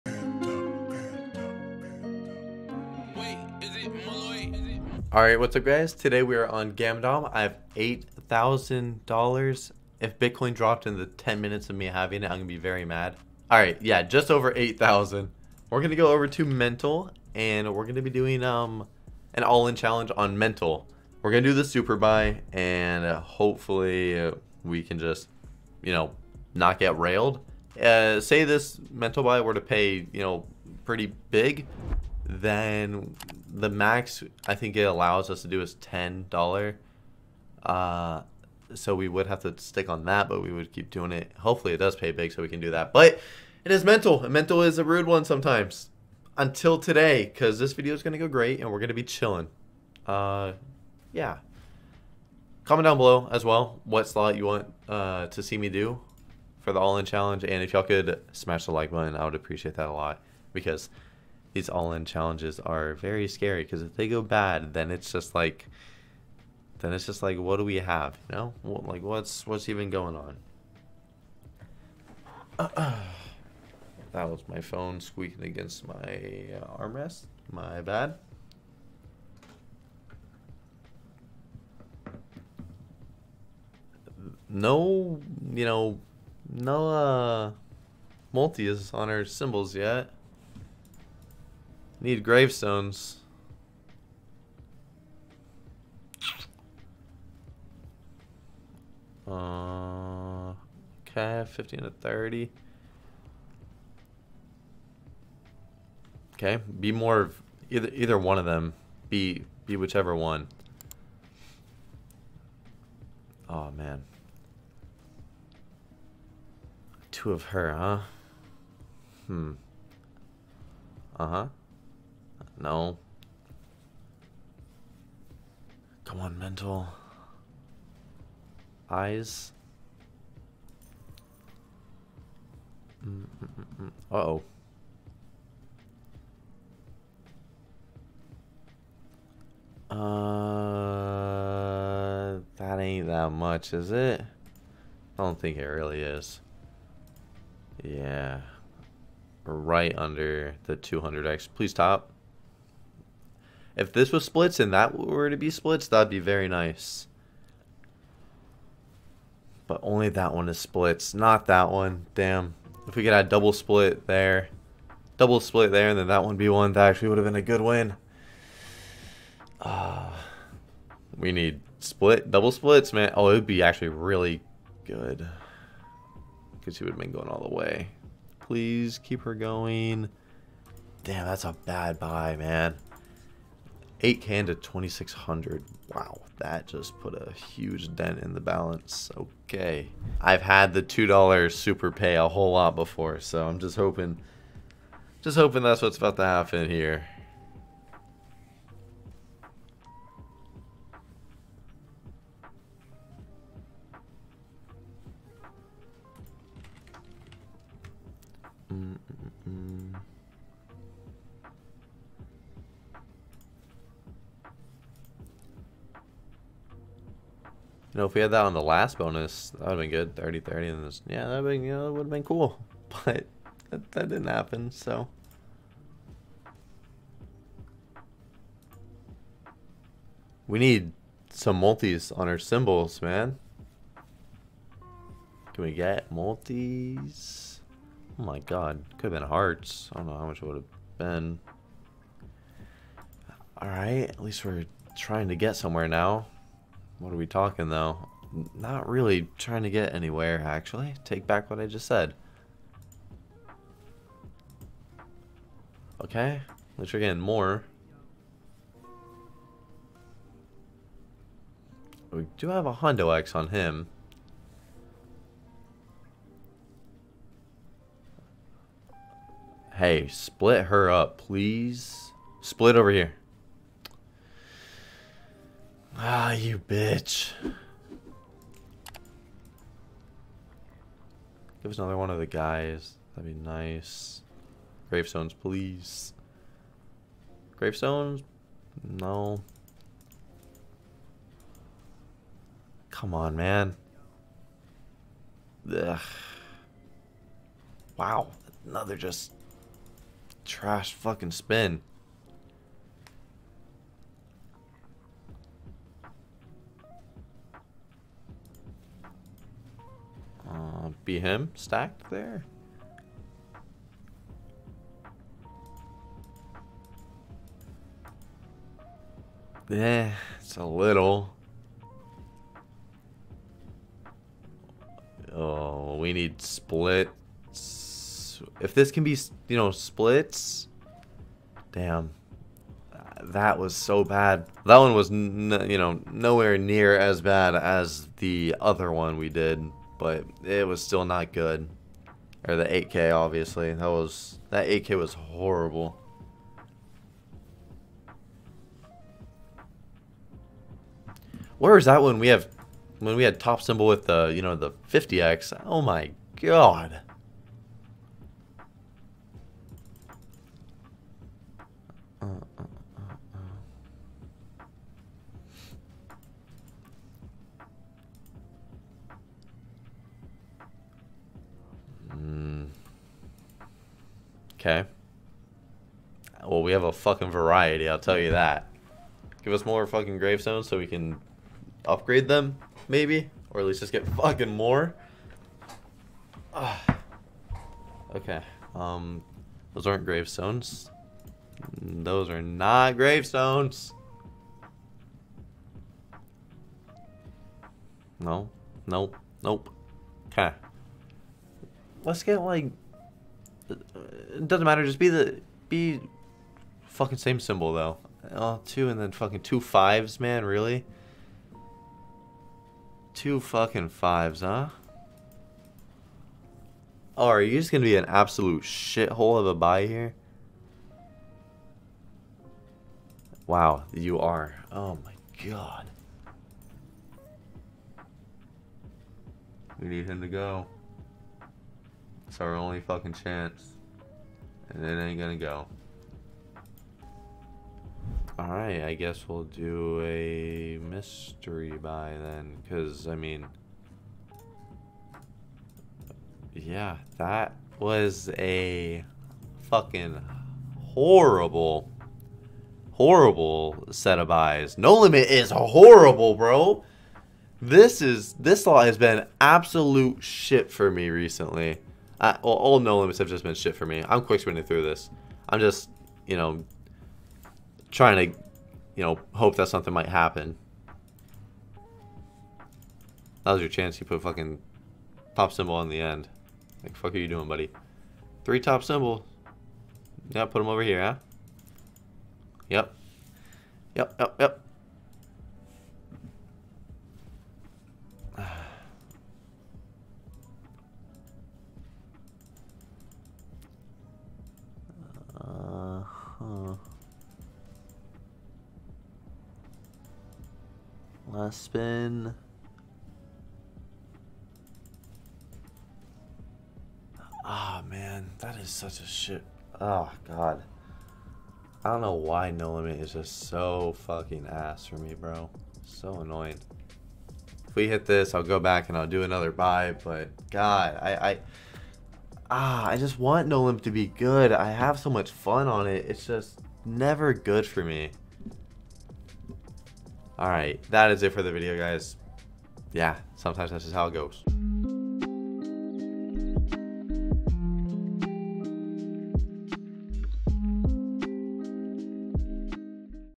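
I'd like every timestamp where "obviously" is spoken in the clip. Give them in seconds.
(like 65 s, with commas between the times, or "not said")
343 s.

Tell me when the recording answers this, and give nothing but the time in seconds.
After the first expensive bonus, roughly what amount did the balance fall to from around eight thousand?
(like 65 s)
184 s.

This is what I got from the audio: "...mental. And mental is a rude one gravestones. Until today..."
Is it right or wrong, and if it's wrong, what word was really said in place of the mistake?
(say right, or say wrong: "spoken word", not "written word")
wrong: "sometimes", not "gravestones".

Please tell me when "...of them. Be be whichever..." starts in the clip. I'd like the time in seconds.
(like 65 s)
108 s.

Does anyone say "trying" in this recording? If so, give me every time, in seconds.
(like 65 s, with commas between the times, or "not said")
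244 s, 249 s, 467 s.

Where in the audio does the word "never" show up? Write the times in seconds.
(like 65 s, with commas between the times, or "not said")
526 s.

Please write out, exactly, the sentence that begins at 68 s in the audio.
You know, what, like what's what's even going on?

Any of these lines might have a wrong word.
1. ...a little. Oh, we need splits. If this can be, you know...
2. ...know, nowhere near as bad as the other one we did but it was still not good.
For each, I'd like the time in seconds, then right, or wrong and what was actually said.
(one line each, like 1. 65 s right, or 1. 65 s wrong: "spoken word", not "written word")
1. 320 s right
2. 335 s right.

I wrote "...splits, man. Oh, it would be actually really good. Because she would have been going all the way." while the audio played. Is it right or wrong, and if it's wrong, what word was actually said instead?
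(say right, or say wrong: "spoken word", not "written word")
right.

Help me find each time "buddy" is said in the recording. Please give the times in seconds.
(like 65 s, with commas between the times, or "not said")
477 s.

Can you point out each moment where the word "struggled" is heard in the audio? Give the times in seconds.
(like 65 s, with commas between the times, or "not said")
not said.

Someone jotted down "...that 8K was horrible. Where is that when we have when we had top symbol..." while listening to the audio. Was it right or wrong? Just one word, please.
right.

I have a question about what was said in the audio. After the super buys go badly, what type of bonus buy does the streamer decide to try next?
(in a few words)
Mystery buy.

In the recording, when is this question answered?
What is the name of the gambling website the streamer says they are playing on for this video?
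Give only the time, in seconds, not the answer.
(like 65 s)
6 s.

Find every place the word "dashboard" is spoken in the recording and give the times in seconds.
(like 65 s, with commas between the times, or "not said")
not said.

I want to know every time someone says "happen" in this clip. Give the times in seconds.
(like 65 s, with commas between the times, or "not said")
196 s, 224 s, 470 s.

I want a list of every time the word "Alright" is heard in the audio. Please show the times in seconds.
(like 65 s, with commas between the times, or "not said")
243 s, 438 s.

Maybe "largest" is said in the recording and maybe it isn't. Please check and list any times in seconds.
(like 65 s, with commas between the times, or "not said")
not said.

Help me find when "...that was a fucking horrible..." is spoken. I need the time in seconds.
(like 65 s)
447 s.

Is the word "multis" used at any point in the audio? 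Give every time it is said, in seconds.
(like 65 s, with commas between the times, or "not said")
88 s, 231 s, 236 s.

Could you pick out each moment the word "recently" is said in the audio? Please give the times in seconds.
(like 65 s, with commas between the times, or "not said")
461 s.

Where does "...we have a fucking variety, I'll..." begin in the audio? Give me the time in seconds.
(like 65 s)
376 s.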